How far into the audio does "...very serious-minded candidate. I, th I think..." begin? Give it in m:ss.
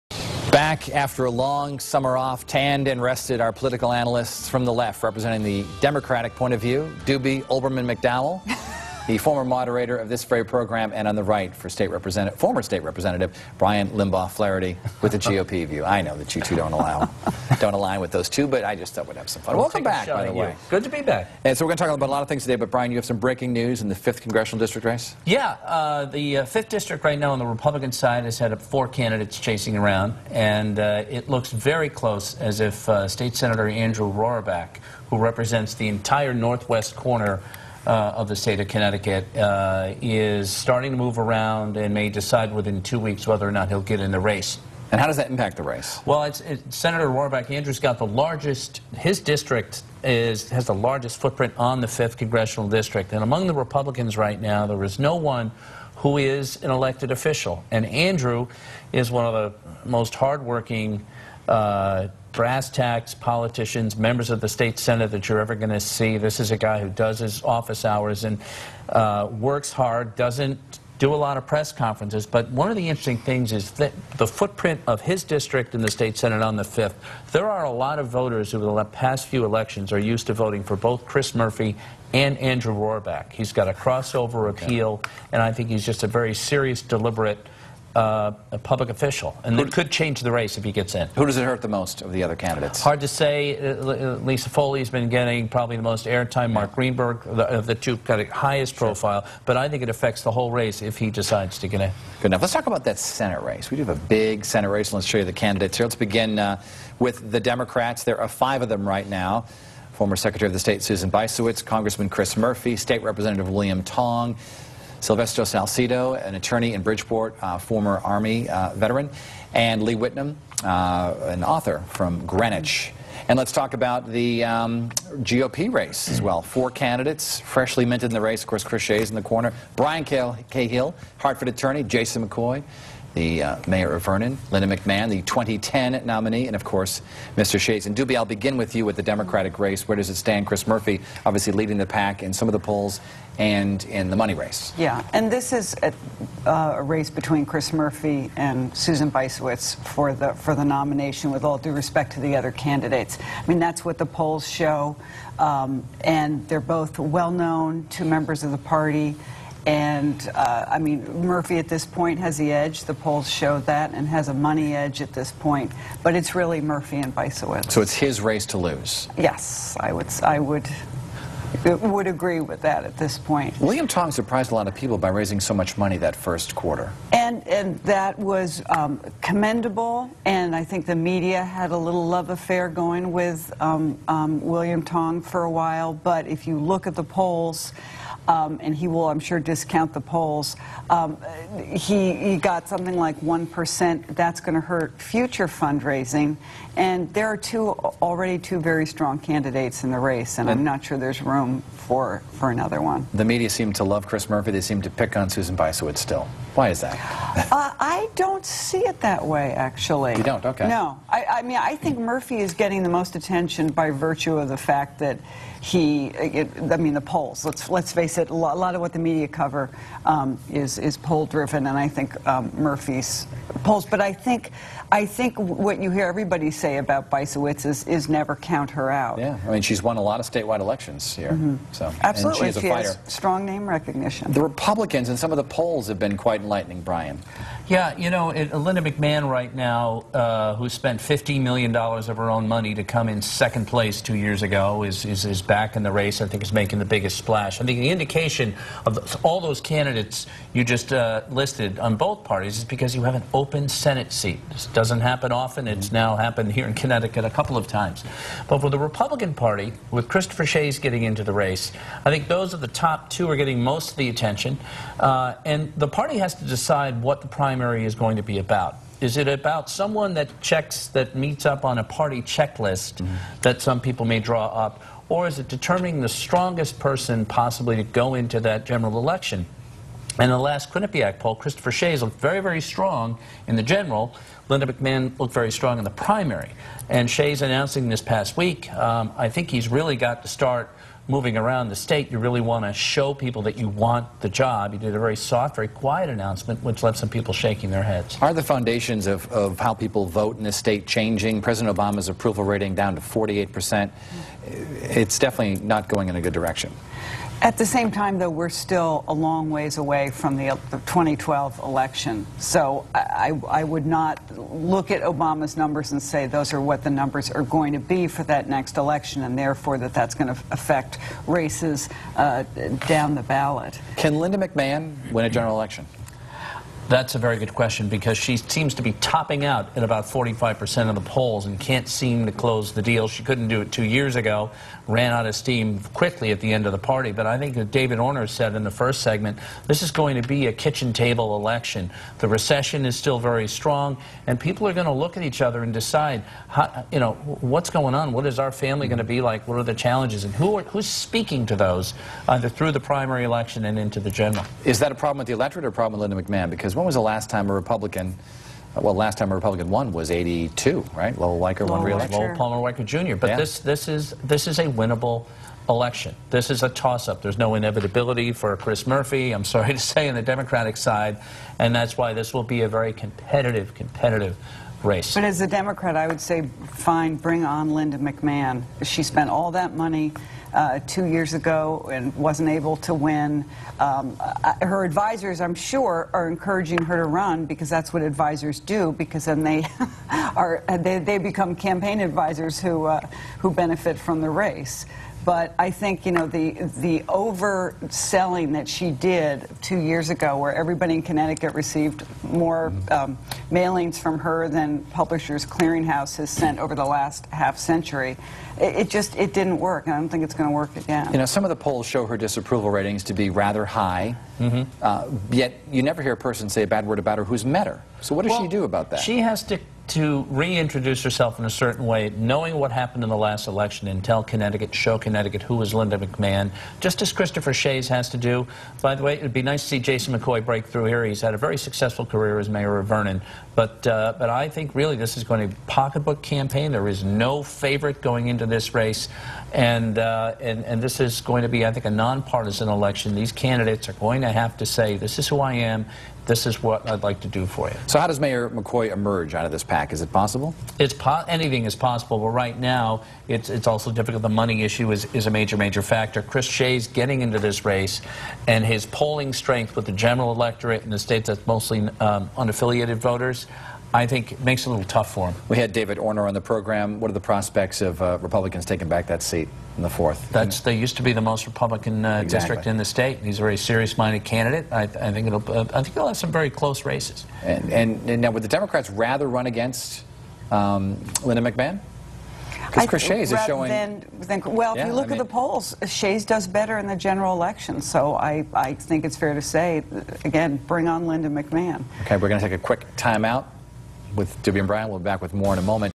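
7:53.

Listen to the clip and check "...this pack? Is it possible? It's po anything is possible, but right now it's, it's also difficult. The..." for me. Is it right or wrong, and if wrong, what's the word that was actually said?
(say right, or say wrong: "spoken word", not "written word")
right.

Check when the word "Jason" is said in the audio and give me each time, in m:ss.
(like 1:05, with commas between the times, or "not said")
2:11, 7:09.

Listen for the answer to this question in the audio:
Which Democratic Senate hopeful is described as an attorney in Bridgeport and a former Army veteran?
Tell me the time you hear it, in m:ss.
1:55.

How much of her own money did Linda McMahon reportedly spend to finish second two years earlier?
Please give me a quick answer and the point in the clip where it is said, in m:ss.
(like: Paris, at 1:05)
$15 million, at 4:00.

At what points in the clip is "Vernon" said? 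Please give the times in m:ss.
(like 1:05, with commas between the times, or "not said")
2:14, 7:12.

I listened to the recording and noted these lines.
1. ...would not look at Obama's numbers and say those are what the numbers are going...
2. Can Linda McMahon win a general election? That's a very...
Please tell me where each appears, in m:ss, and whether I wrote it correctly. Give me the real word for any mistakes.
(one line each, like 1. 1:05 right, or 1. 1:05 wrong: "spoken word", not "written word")
1. 5:13 right
2. 5:23 right.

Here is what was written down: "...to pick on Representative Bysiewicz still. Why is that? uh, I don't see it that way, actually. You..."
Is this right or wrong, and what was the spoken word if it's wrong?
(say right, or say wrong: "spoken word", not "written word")
wrong: "Susan", not "Representative".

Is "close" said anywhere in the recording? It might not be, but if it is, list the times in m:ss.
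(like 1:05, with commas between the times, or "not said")
0:31, 5:32, 7:56.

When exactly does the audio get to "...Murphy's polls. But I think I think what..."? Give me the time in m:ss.
3:42.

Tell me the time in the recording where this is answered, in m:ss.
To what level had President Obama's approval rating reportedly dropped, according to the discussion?
5:03.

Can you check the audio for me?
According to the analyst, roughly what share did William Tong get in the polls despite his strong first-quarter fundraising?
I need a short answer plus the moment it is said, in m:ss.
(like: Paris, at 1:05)
1%, at 3:13.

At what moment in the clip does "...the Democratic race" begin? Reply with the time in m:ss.
2:18.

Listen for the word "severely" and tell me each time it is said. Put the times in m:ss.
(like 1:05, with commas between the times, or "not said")
not said.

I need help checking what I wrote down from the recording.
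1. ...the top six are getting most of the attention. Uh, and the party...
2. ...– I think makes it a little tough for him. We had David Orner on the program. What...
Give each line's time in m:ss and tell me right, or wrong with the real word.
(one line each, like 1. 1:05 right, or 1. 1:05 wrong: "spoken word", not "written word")
1. 4:22 wrong: "two", not "six"
2. 7:43 right.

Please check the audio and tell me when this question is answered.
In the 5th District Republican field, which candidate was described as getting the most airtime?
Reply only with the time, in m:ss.
1:34.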